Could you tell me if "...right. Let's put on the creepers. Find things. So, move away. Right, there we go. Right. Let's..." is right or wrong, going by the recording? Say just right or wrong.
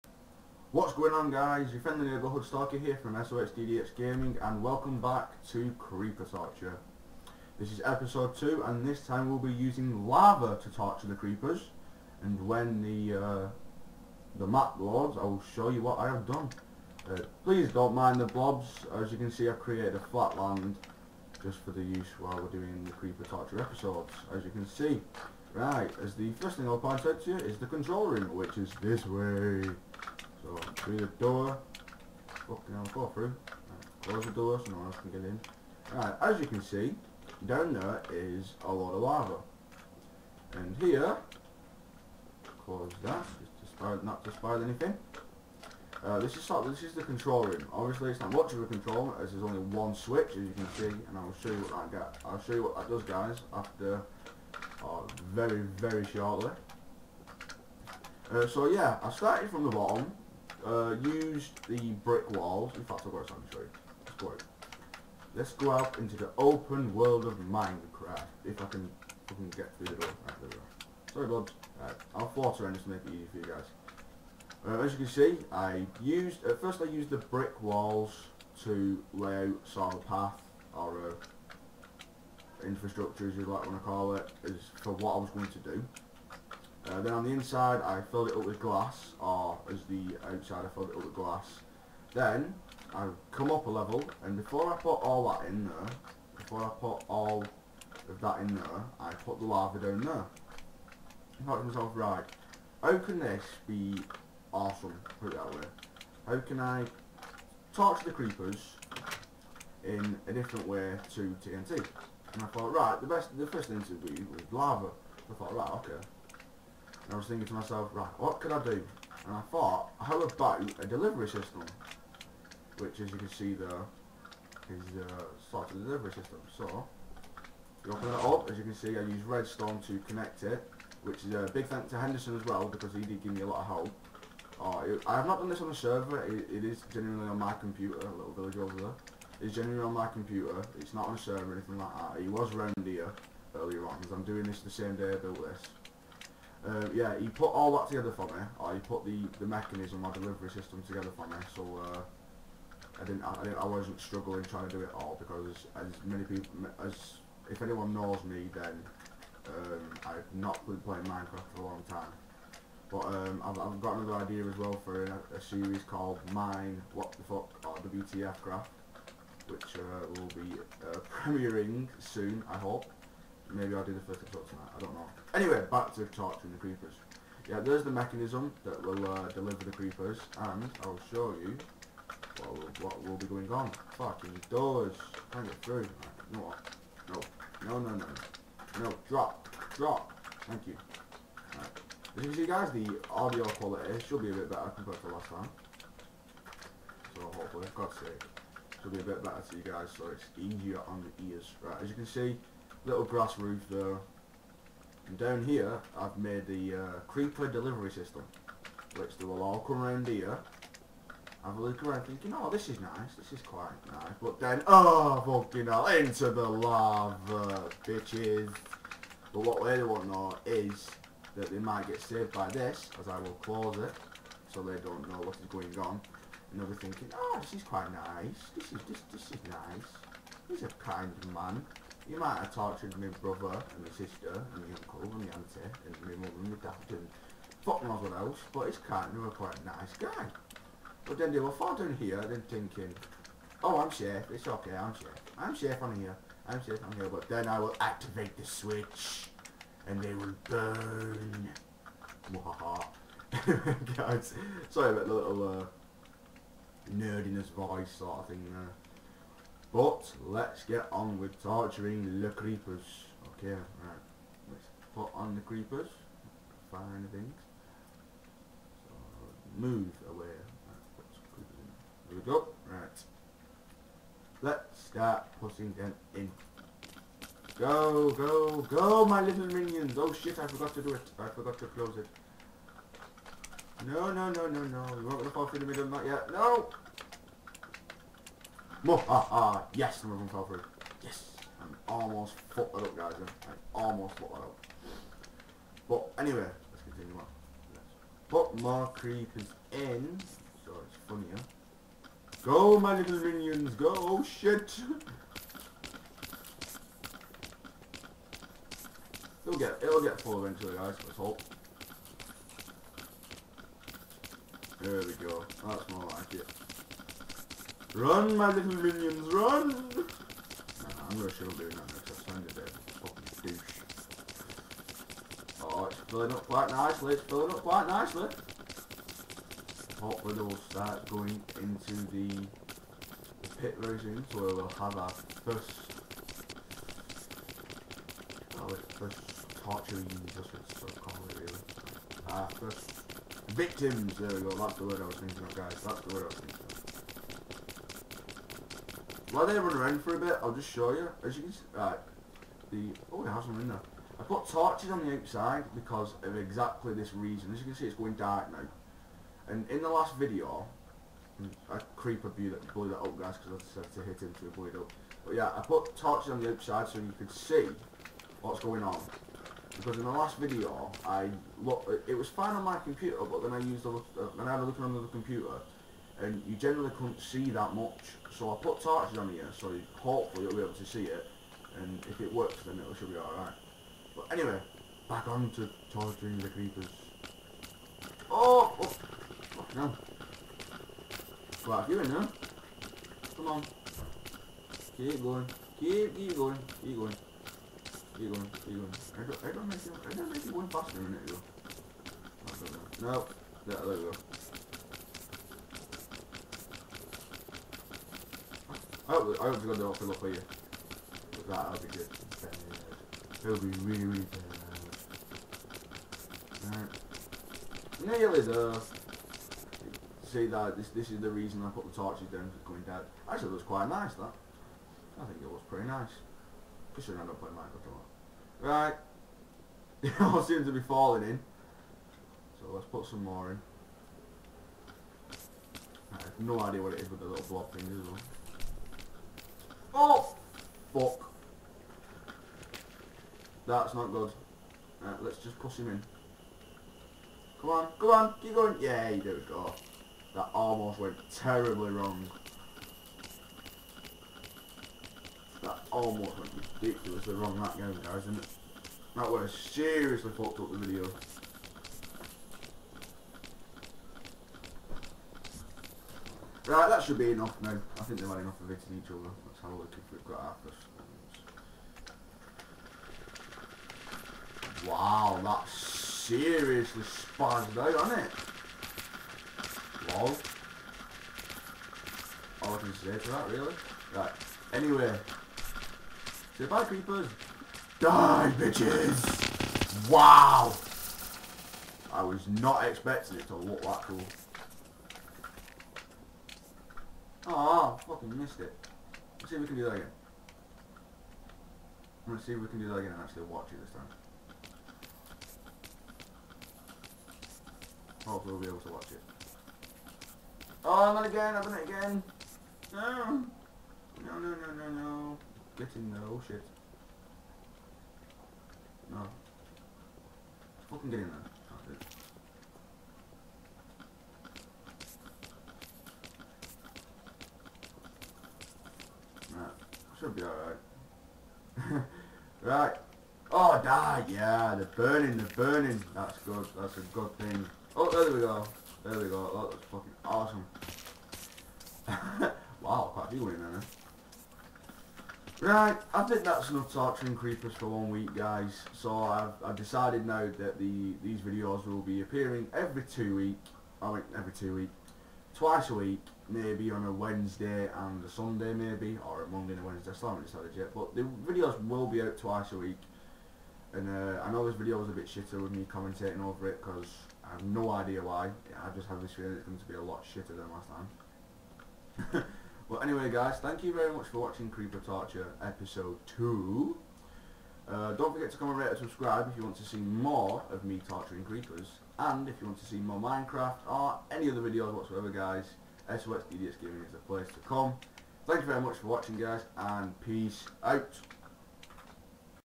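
right.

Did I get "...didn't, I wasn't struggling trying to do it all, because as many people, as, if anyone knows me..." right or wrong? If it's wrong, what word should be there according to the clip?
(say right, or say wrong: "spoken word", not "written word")
right.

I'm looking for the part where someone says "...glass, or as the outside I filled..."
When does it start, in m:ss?
1:28.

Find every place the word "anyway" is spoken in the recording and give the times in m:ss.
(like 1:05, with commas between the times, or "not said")
2:55, 4:56, 6:24, 8:04, 9:33.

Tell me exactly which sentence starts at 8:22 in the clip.
I'm gonna see if we can do that again and actually watch it this time.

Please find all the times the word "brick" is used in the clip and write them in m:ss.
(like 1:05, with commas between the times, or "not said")
1:02, 1:17.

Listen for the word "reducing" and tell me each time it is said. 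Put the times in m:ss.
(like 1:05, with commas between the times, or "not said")
not said.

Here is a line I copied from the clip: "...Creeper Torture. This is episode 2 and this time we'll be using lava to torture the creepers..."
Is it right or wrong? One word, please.
right.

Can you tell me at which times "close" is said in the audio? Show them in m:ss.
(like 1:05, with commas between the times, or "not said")
0:34, 0:42, 3:43, 4:41.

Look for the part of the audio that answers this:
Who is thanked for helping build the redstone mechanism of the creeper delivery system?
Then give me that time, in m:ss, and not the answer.
2:11.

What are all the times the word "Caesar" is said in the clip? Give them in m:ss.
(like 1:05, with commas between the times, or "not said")
not said.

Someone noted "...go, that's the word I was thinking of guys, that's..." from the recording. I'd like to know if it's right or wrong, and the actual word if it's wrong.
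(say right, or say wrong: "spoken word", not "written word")
right.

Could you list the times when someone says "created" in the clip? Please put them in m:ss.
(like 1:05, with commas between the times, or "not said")
0:19.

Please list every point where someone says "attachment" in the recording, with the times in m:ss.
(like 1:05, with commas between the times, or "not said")
not said.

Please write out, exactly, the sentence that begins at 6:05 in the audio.
But yeah, I put torches on the outside so you could see what's going on.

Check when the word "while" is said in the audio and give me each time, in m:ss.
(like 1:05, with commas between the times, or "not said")
0:22, 5:49.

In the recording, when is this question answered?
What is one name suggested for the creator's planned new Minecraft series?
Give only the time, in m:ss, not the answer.
2:47.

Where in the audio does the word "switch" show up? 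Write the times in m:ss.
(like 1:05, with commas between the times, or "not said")
0:49, 4:08.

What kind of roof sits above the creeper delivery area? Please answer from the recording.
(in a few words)
grass roof.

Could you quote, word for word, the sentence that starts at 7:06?
We should end up playing Minecraft a lot.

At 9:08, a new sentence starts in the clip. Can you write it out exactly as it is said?
So I've, I've decided now that the these videos will be appearing every two week.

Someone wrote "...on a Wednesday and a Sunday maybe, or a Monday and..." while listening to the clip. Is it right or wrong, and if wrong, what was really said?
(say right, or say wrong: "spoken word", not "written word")
right.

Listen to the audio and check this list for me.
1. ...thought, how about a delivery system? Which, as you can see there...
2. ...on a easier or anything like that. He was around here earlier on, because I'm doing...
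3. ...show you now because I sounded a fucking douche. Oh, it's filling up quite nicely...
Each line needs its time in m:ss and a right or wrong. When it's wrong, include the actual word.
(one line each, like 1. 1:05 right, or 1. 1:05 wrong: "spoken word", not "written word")
1. 1:59 right
2. 2:21 wrong: "server", not "easier"
3. 5:21 right.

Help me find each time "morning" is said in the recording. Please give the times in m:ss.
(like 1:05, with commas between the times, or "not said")
not said.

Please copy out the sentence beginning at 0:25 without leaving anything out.
Right, as the first thing I'll point out to you is the control room, which is this way.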